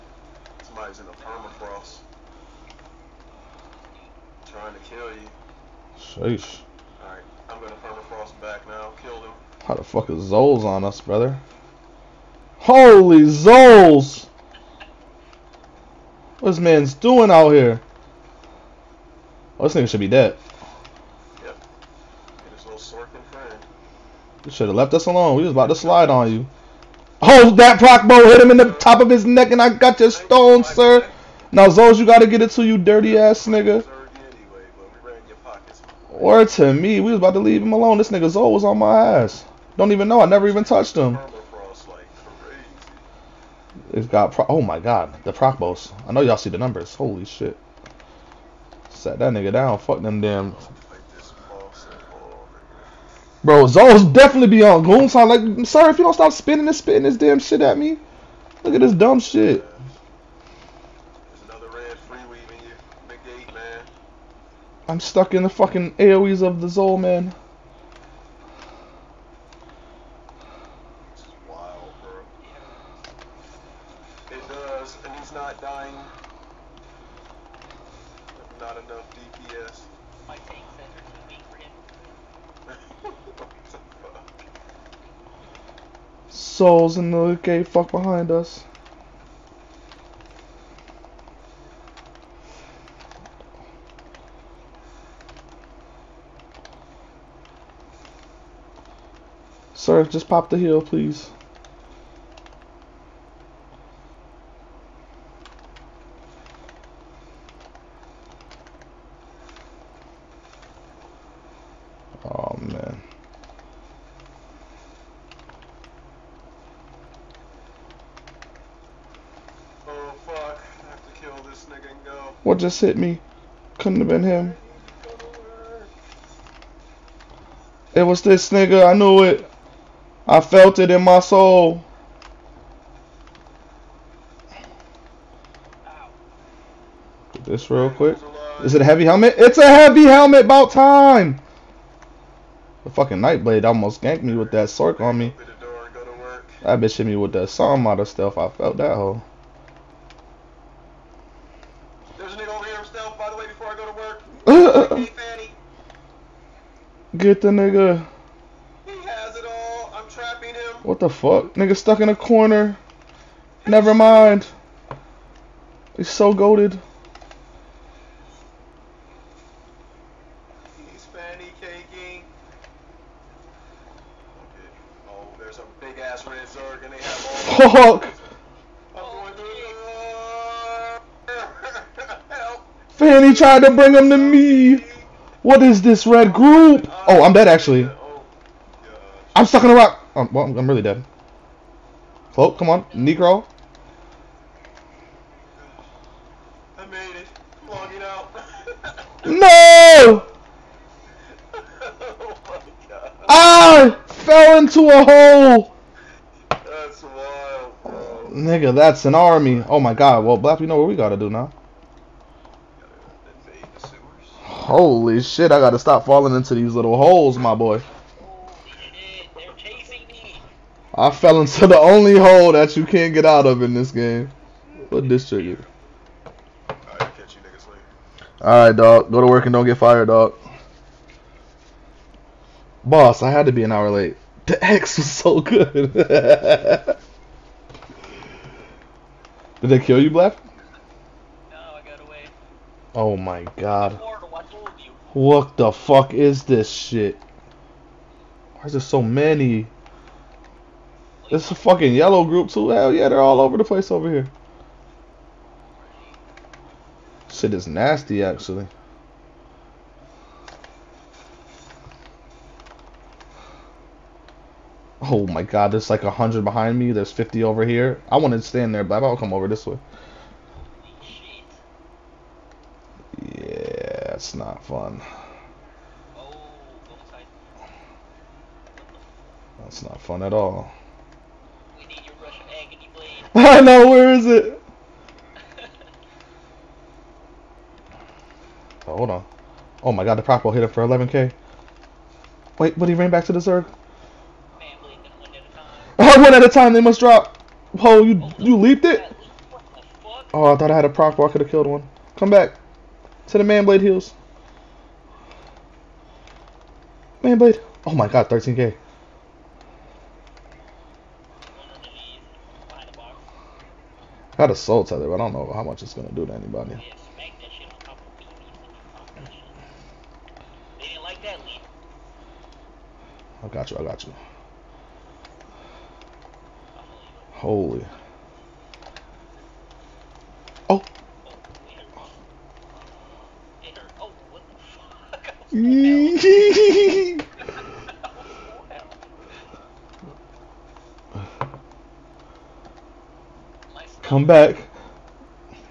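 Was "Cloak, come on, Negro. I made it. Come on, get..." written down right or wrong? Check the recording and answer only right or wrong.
right.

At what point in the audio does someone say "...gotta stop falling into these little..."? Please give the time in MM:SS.
03:35.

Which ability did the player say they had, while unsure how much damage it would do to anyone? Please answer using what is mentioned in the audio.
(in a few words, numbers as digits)
soul tether.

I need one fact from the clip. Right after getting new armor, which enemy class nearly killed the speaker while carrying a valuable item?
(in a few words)
Nightblade.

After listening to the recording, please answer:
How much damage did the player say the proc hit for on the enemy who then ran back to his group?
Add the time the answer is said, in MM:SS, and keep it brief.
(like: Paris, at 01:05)
11k, at 04:50.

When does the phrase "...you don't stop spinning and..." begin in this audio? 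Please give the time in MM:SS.
00:55.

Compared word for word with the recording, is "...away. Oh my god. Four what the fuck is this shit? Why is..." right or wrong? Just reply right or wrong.
right.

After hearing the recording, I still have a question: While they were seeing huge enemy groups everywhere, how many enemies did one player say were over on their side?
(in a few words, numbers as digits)
50.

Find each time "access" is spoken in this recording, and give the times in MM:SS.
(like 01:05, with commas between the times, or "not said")
not said.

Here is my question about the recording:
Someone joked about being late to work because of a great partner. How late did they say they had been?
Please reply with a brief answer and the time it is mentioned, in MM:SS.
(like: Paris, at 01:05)
an hour, at 03:53.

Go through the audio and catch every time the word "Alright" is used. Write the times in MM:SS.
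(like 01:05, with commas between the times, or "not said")
00:07, 03:48.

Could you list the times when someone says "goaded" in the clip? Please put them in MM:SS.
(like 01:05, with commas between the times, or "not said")
02:46.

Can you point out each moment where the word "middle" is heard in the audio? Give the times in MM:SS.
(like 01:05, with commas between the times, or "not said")
not said.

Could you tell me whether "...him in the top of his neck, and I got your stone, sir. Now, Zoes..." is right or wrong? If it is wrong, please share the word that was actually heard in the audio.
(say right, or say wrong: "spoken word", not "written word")
right.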